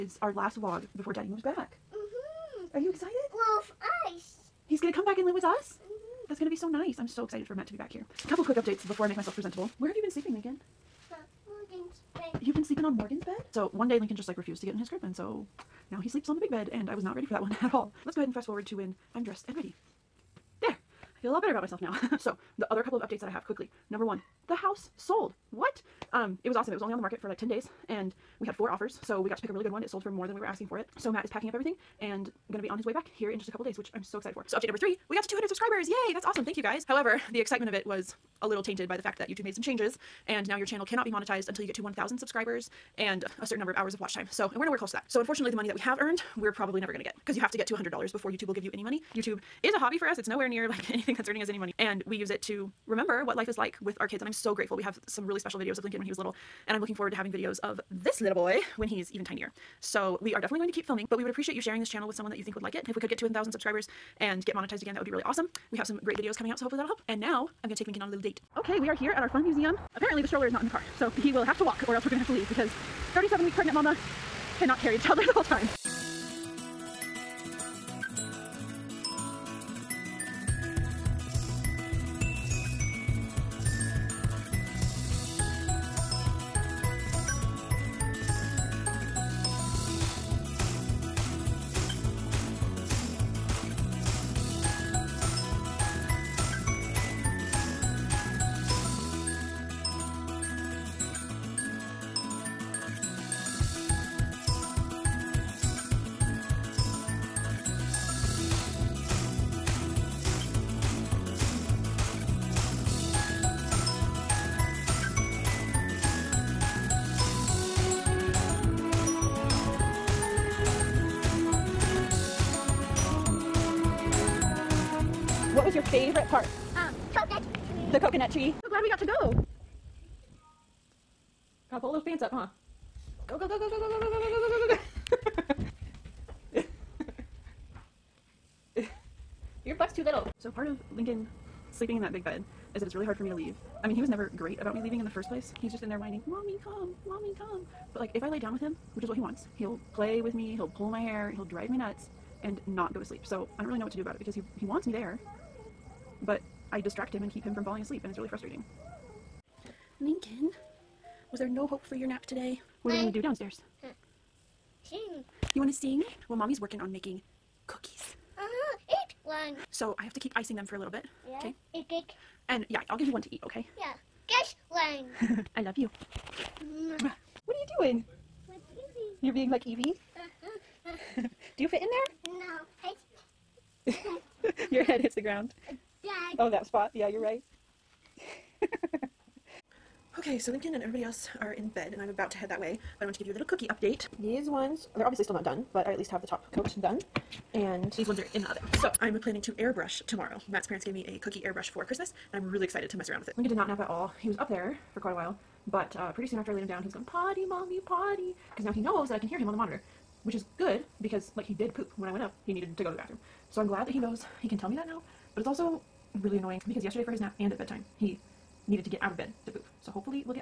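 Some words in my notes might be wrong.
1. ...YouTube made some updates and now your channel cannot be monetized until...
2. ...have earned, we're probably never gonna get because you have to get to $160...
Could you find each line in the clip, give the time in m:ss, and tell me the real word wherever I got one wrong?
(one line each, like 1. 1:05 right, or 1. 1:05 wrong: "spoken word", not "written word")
1. 0:39 wrong: "changes", not "updates"
2. 0:45 wrong: "100", not "160".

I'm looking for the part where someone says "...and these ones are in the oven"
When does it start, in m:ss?
3:17.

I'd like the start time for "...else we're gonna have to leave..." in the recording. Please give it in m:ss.
1:11.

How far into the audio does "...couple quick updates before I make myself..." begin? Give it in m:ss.
0:08.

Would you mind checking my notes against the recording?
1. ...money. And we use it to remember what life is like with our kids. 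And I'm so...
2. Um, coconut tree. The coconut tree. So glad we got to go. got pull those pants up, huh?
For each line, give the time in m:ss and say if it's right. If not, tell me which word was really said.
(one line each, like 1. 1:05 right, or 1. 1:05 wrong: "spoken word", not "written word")
1. 0:51 right
2. 2:06 right.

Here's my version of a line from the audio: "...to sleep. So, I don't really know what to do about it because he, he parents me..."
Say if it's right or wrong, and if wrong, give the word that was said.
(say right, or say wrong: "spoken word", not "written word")
wrong: "wants", not "parents".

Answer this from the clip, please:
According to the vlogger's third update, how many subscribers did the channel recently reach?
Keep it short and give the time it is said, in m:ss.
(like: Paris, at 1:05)
200, at 0:35.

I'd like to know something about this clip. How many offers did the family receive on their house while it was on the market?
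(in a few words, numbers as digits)
4.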